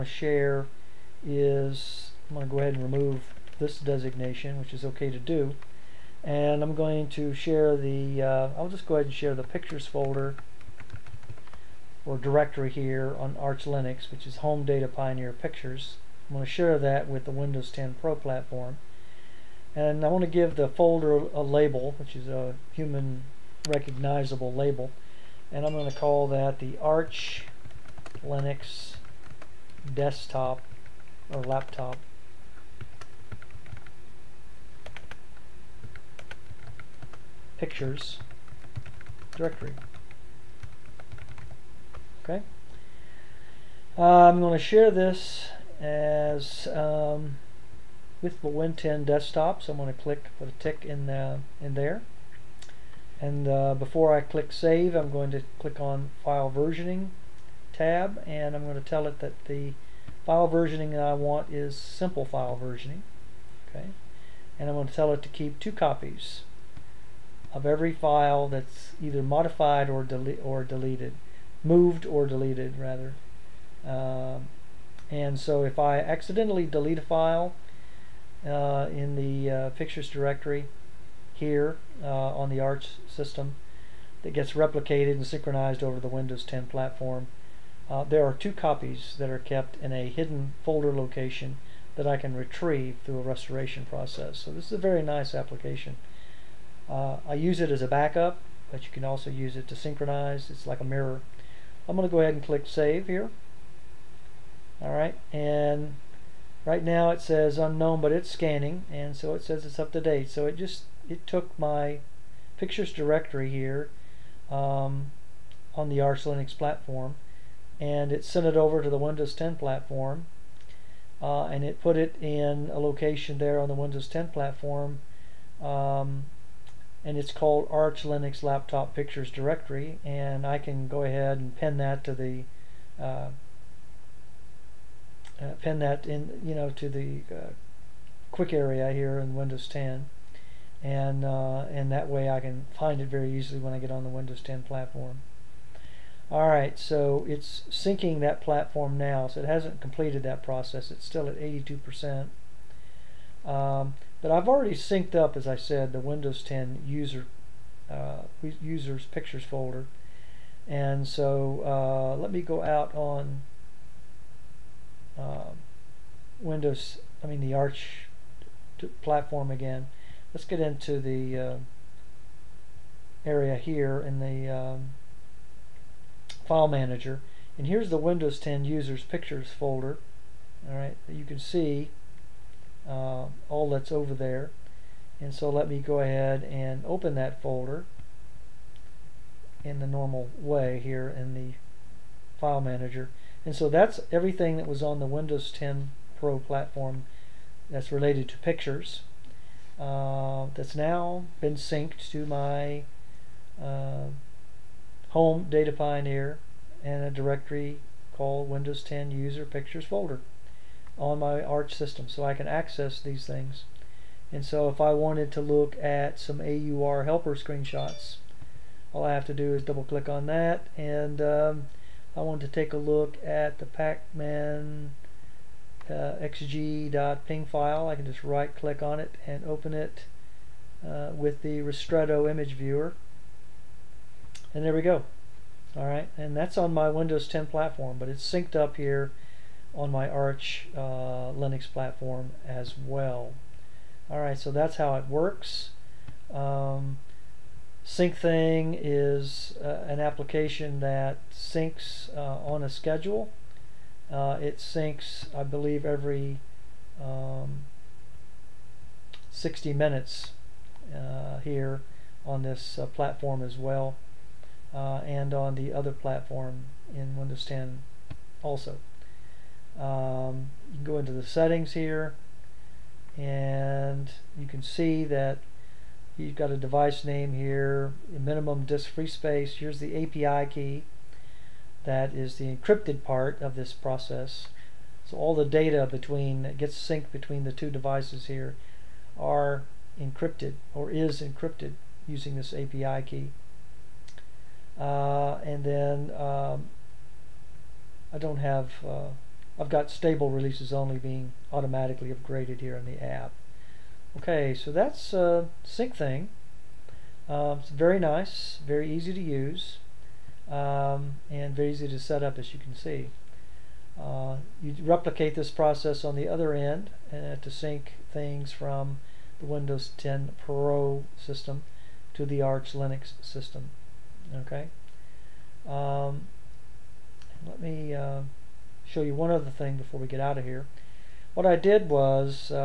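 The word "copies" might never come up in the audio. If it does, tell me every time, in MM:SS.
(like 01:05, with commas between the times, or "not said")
01:05, 01:28.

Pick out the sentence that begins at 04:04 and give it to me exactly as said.
Alright, so that's how it works.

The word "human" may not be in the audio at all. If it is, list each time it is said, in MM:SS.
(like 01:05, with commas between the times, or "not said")
00:22.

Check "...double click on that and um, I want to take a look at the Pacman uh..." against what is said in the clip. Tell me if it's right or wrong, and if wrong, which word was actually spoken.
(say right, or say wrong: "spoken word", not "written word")
right.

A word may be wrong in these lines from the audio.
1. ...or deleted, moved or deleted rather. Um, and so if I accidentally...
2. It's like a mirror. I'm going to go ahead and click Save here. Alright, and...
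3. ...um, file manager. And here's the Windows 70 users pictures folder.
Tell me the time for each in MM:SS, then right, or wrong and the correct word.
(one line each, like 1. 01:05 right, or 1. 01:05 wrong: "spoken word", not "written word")
1. 01:10 right
2. 01:40 right
3. 02:54 wrong: "10", not "70".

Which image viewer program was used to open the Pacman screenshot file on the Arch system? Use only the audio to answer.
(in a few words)
Ristretto.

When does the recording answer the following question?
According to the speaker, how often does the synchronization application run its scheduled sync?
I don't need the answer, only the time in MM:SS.
04:19.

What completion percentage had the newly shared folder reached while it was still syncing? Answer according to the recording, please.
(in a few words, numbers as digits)
82 percent.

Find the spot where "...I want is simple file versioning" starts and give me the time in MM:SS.
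01:01.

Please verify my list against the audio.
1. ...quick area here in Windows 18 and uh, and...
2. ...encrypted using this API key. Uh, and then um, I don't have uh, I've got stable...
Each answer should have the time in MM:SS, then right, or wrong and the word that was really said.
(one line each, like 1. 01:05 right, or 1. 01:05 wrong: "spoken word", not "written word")
1. 02:18 wrong: "10", not "18"
2. 04:51 right.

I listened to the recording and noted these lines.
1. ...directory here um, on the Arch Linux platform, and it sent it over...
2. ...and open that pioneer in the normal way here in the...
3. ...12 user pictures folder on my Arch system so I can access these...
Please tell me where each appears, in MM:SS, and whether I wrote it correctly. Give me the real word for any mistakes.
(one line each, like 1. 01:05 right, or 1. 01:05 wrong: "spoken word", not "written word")
1. 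01:52 right
2. 03:06 wrong: "folder", not "pioneer"
3. 03:28 wrong: "10", not "12".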